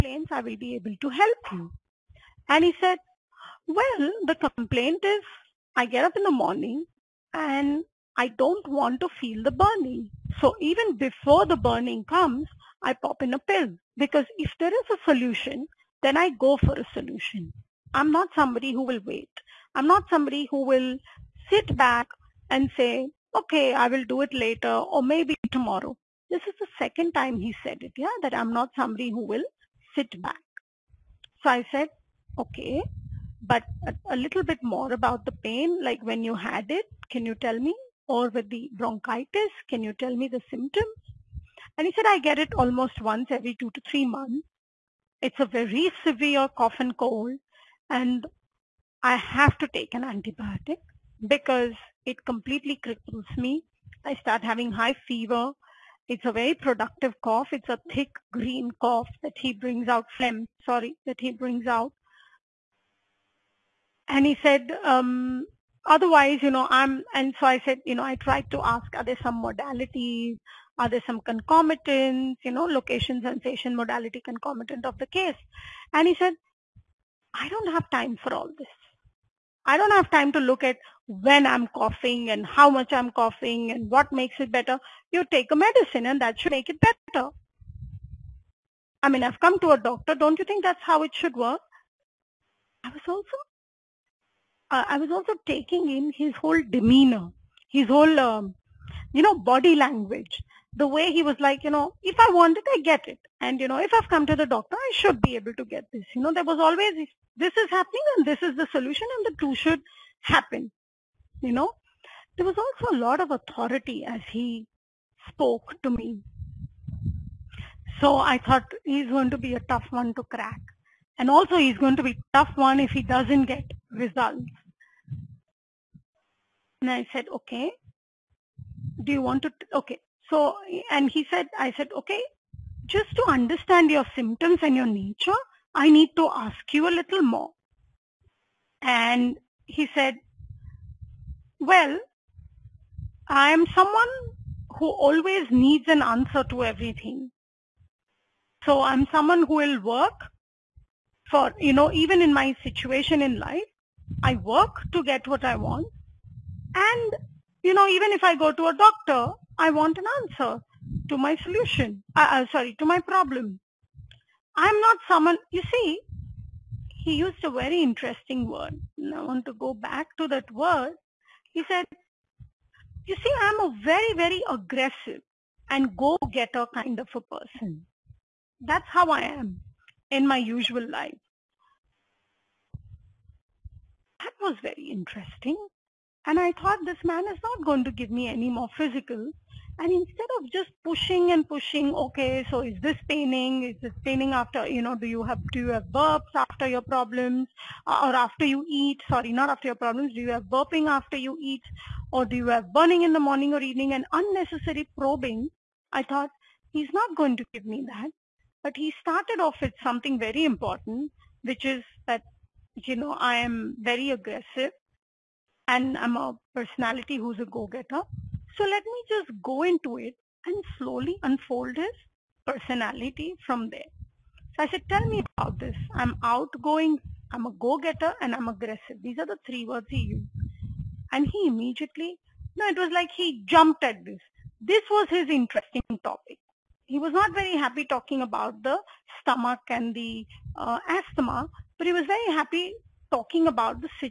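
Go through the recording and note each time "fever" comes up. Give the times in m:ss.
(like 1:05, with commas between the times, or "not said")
0:55.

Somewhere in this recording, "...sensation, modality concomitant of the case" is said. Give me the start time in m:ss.
1:13.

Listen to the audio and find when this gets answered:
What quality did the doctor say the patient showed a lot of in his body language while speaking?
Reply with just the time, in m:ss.
1:53.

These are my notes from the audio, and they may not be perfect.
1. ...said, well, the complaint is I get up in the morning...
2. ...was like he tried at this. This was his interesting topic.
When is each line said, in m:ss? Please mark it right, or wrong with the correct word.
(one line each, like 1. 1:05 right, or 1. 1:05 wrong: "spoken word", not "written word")
1. 0:02 right
2. 3:52 wrong: "jumped", not "tried".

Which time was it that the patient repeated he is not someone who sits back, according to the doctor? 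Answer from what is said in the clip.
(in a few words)
second.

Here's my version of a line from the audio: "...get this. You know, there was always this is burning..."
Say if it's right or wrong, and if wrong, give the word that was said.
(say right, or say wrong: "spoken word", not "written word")
wrong: "happening", not "burning".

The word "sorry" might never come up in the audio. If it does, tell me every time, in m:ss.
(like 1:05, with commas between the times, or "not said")
1:00, 2:42, 3:19.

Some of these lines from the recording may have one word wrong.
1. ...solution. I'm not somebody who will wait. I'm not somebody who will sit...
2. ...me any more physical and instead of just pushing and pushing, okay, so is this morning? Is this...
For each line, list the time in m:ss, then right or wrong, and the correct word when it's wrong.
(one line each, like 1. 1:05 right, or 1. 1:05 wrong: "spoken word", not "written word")
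1. 0:16 right
2. 3:08 wrong: "paining", not "morning".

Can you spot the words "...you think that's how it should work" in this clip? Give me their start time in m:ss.
1:30.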